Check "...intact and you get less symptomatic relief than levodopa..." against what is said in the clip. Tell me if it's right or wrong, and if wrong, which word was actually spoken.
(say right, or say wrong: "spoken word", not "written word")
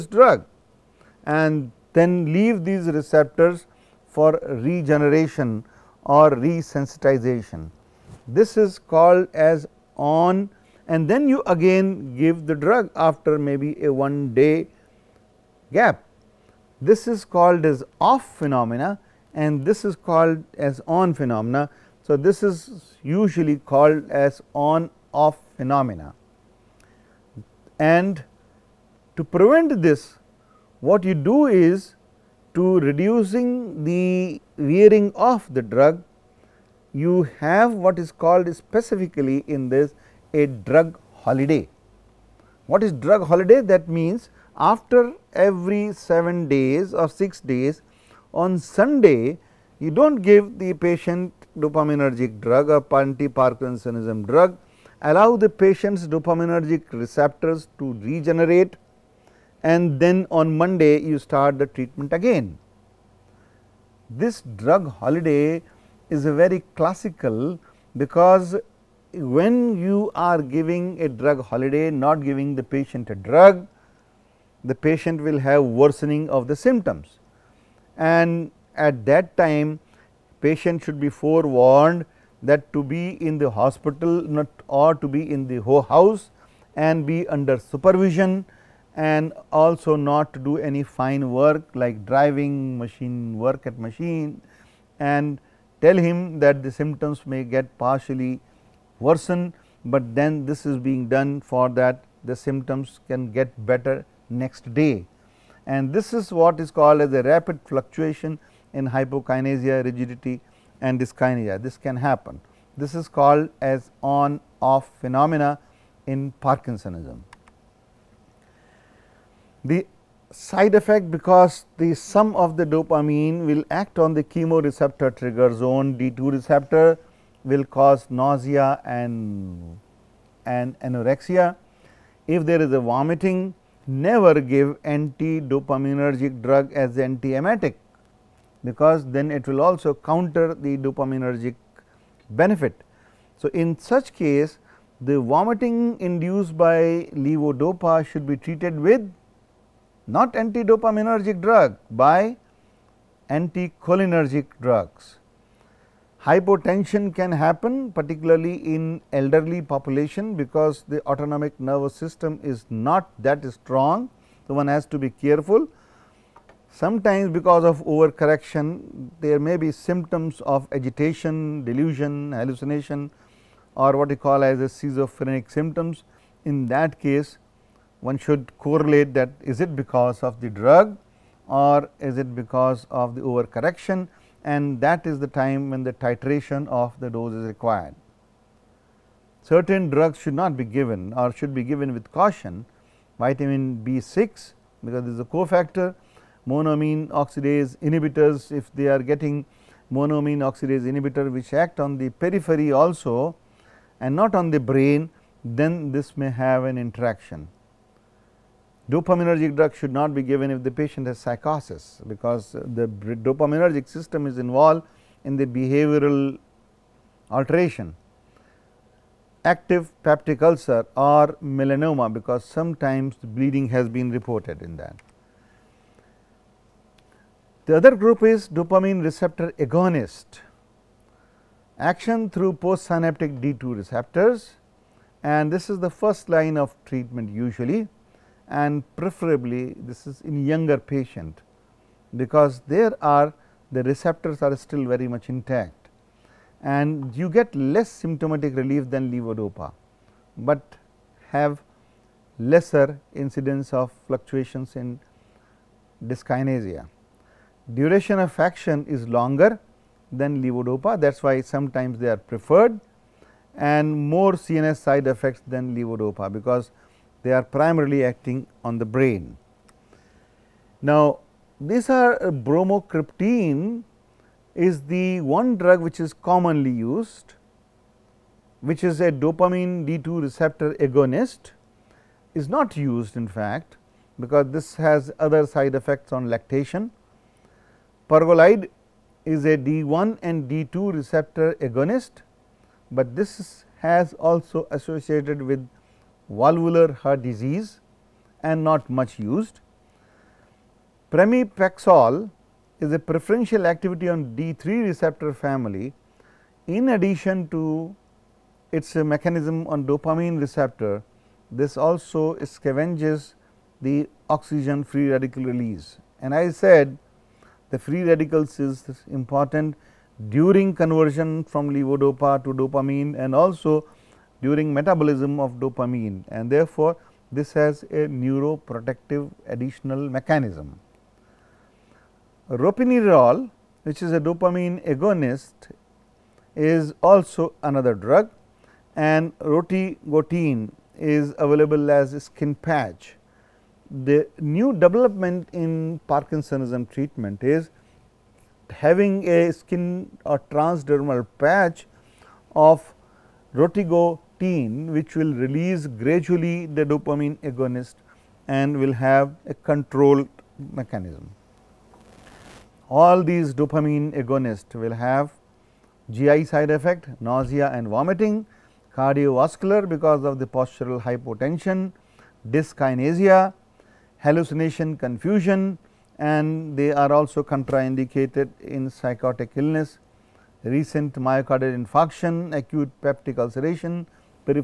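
right.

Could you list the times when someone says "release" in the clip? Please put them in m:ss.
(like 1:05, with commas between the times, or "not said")
5:15, 5:55.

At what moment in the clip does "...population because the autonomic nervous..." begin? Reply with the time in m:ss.
2:39.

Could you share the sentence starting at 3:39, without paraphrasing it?
Active peptic ulcer or melanoma because sometimes bleeding has been reported in that.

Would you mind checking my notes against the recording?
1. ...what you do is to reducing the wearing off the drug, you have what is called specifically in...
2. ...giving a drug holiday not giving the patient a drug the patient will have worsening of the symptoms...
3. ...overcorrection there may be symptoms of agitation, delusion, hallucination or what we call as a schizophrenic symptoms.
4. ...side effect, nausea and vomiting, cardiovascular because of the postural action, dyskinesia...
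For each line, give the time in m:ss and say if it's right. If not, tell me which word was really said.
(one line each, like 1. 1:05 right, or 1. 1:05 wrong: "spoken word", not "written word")
1. 0:30 right
2. 1:10 right
3. 2:47 right
4. 6:06 wrong: "hypotension", not "action".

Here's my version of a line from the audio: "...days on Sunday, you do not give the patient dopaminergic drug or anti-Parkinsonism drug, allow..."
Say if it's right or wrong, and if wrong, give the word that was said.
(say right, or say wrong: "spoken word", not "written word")
right.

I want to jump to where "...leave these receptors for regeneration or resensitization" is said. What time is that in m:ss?
0:02.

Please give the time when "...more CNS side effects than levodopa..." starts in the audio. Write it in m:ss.
4:24.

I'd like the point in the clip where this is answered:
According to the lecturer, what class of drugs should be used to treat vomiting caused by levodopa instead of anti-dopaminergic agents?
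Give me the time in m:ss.
2:33.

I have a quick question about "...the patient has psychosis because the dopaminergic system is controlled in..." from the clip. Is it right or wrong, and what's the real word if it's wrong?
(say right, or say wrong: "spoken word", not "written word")
wrong: "involved", not "controlled".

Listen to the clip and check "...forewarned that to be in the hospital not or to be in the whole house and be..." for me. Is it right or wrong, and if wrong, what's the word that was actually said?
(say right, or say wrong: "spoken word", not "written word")
right.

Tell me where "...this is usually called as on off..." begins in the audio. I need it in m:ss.
0:22.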